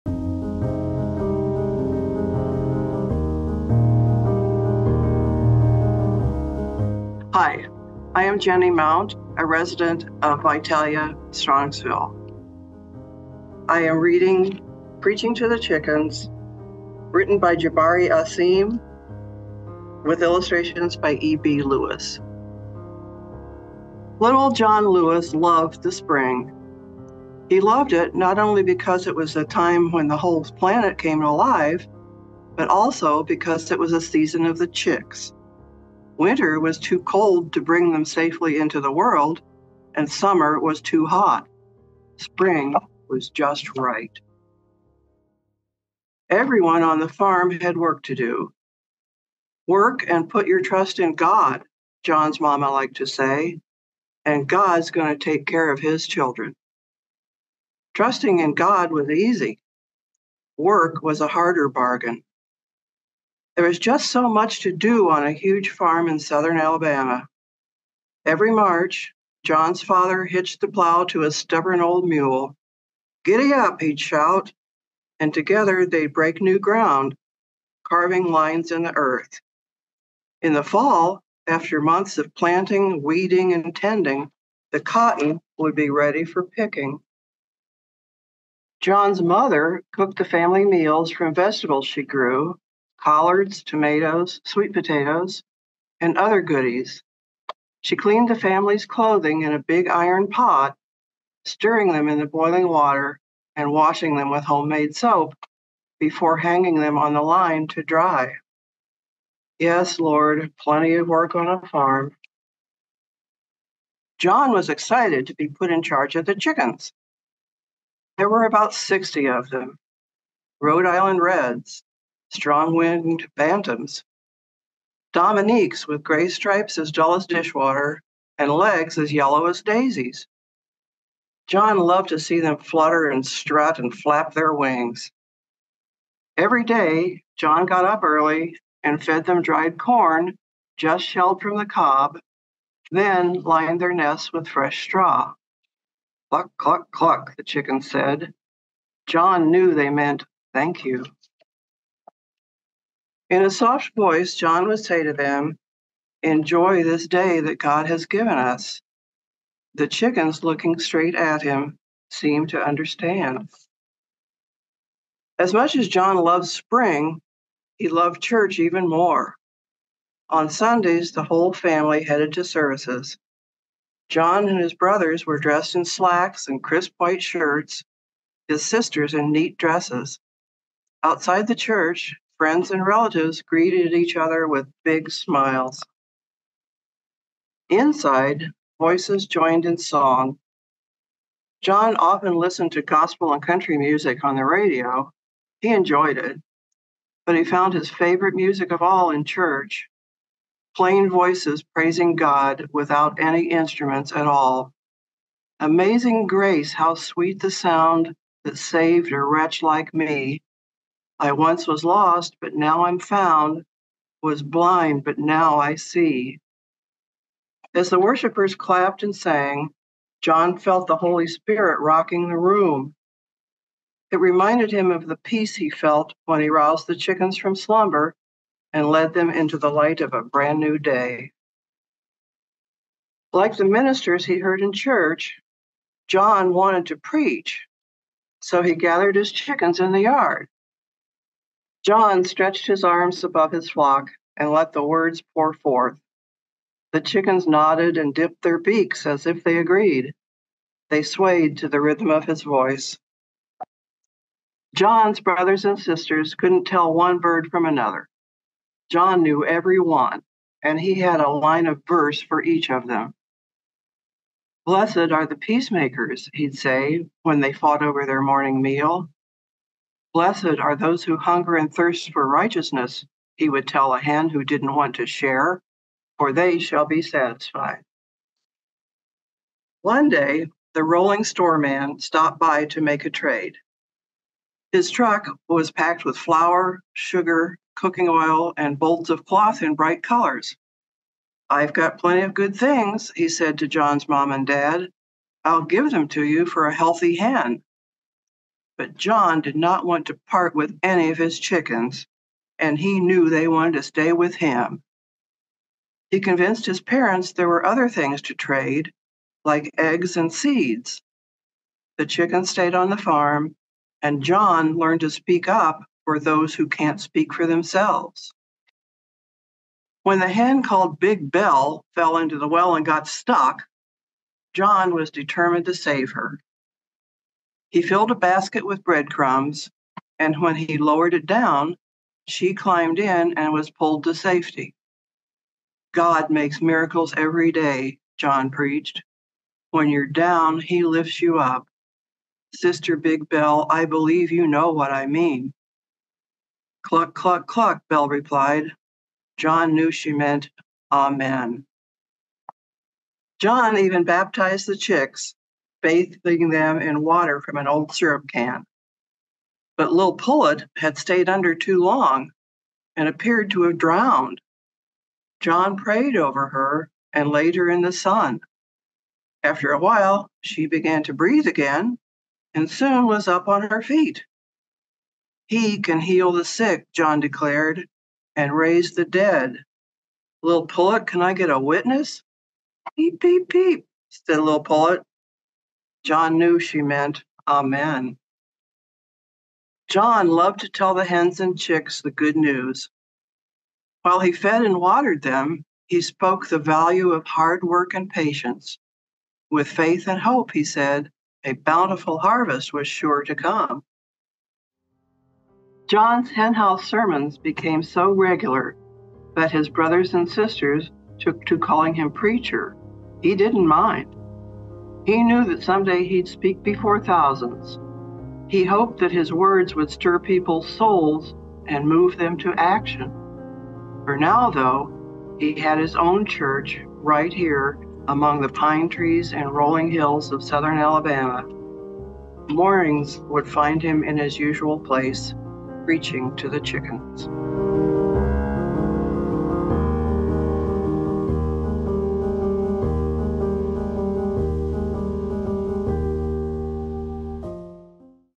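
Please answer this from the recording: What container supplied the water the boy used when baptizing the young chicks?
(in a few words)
old syrup can.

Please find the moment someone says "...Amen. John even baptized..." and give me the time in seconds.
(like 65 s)
350 s.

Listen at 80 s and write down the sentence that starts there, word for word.
In the fall, after months of planting, weeding, and tending, the cotton would be ready for picking.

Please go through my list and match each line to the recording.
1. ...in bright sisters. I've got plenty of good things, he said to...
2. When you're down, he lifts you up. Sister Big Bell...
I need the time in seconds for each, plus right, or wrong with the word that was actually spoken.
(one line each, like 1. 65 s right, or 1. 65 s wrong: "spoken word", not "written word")
1. 289 s wrong: "colors", not "sisters"
2. 339 s right.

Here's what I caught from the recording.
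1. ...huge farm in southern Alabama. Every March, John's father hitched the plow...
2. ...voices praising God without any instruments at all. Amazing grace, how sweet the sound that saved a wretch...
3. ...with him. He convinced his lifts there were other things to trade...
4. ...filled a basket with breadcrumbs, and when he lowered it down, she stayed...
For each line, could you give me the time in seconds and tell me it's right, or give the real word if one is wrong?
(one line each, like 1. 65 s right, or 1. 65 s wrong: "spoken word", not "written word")
1. 65 s right
2. 201 s right
3. 304 s wrong: "parents", not "lifts"
4. 327 s wrong: "climbed", not "stayed".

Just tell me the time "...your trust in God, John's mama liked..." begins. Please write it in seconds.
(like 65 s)
50 s.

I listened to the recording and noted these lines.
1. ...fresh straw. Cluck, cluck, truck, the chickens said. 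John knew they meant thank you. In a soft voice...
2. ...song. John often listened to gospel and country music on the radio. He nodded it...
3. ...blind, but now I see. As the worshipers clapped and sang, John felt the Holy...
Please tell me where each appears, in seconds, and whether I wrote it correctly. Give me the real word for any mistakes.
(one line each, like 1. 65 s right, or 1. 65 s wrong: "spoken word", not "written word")
1. 144 s wrong: "cluck", not "truck"
2. 189 s wrong: "enjoyed", not "nodded"
3. 214 s right.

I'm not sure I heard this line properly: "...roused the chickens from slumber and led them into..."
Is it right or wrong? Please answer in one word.
right.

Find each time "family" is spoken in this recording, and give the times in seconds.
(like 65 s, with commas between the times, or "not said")
90 s, 98 s, 171 s.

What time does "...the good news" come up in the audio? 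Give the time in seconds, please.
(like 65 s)
392 s.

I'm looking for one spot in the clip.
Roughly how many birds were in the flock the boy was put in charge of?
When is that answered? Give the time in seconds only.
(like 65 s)
118 s.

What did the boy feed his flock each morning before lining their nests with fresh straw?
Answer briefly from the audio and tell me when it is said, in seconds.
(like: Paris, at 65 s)
dried corn, at 139 s.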